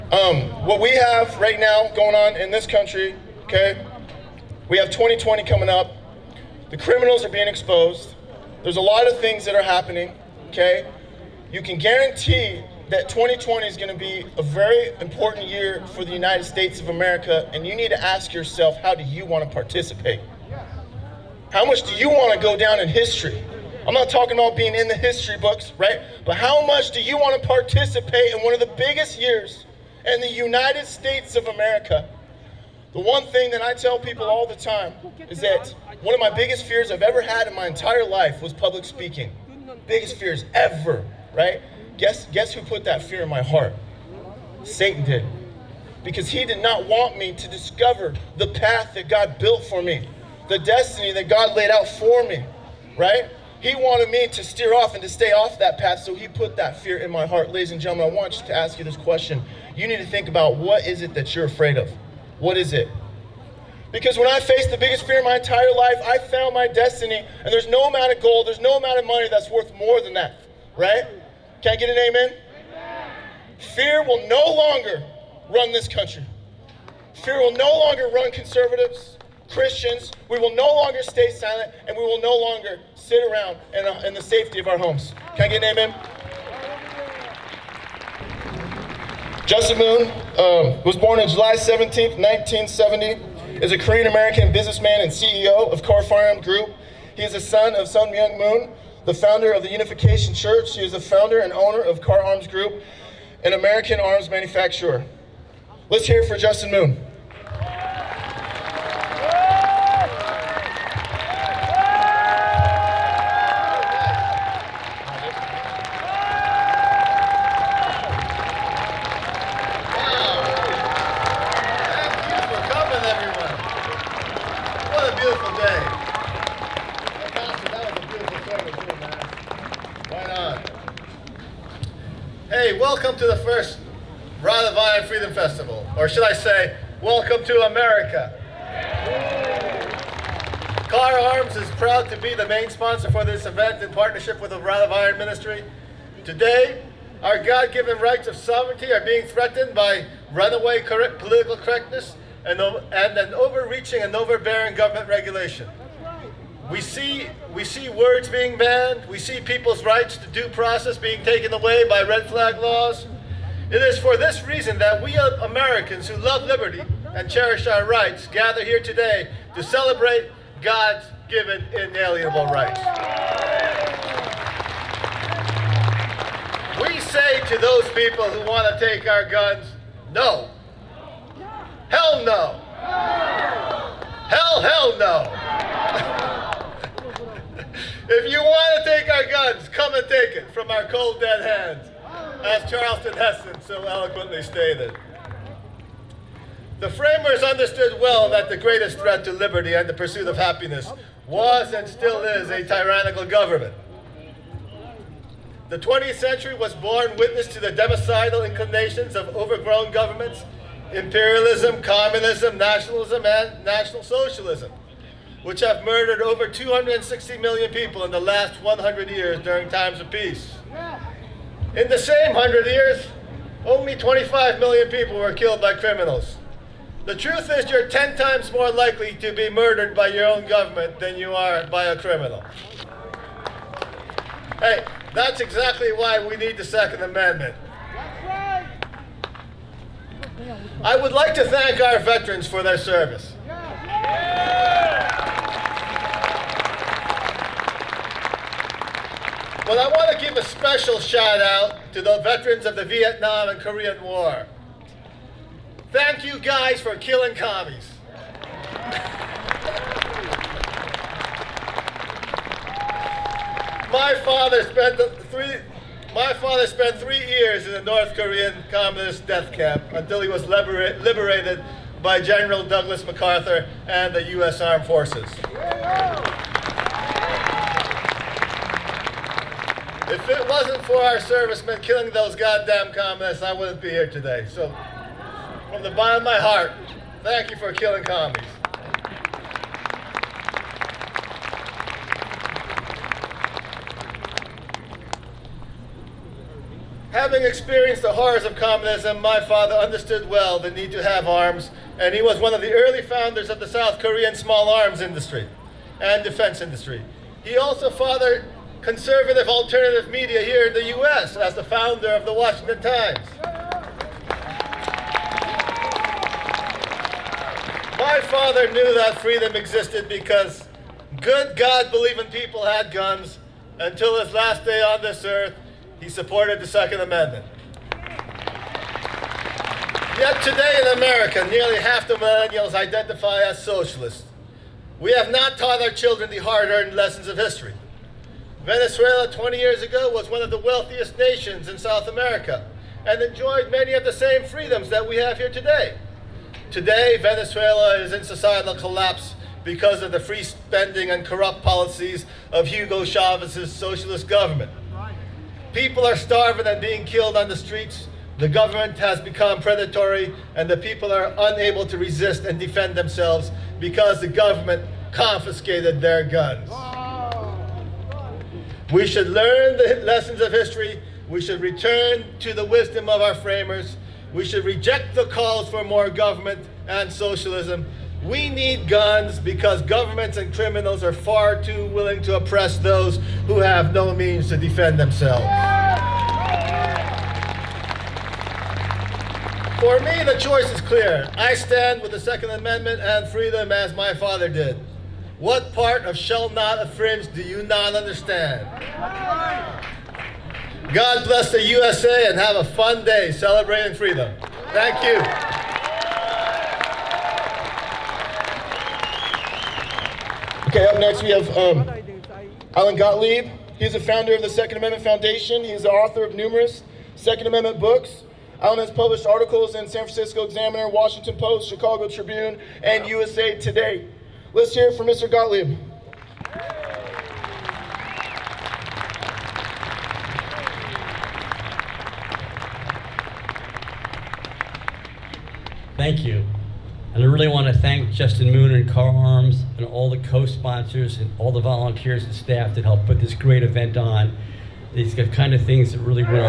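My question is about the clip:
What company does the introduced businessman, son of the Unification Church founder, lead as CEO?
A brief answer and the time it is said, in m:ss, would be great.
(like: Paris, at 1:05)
Kahr Firearms Group, at 1:35.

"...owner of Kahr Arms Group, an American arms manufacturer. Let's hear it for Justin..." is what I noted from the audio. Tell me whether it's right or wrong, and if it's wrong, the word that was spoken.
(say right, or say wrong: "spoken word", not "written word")
right.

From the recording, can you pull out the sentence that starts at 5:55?
People are starving and being killed on the streets.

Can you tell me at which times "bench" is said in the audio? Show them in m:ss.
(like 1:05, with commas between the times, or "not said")
not said.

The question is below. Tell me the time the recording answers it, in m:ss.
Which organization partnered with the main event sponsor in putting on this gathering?
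2:24.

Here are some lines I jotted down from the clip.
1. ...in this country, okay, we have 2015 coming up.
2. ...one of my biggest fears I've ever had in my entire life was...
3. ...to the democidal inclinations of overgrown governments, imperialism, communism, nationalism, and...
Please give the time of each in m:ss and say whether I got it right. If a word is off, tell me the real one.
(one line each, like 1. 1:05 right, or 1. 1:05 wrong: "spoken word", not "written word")
1. 0:02 wrong: "2020", not "2015"
2. 0:36 right
3. 3:27 right.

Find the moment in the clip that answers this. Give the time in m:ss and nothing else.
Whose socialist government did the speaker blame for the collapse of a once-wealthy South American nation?
5:52.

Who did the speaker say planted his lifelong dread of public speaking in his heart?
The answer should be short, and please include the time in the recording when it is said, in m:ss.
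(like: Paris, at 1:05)
Satan, at 0:44.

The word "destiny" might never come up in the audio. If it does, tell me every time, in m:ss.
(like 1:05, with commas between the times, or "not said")
0:50, 1:06.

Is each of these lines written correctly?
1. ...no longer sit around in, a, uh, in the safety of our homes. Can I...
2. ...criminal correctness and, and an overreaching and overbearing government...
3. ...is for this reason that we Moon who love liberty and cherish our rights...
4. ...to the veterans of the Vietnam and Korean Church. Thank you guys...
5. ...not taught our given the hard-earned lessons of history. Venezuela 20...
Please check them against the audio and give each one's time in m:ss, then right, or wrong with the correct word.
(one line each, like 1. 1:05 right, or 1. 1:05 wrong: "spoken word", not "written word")
1. 1:22 right
2. 2:31 wrong: "political", not "criminal"
3. 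2:43 wrong: "Americans", not "Moon"
4. 4:11 wrong: "War", not "Church"
5. 5:35 wrong: "children", not "given".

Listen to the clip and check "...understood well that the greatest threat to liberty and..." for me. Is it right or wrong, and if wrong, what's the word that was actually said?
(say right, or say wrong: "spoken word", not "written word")
right.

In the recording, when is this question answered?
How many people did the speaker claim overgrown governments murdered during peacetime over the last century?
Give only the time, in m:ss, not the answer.
3:36.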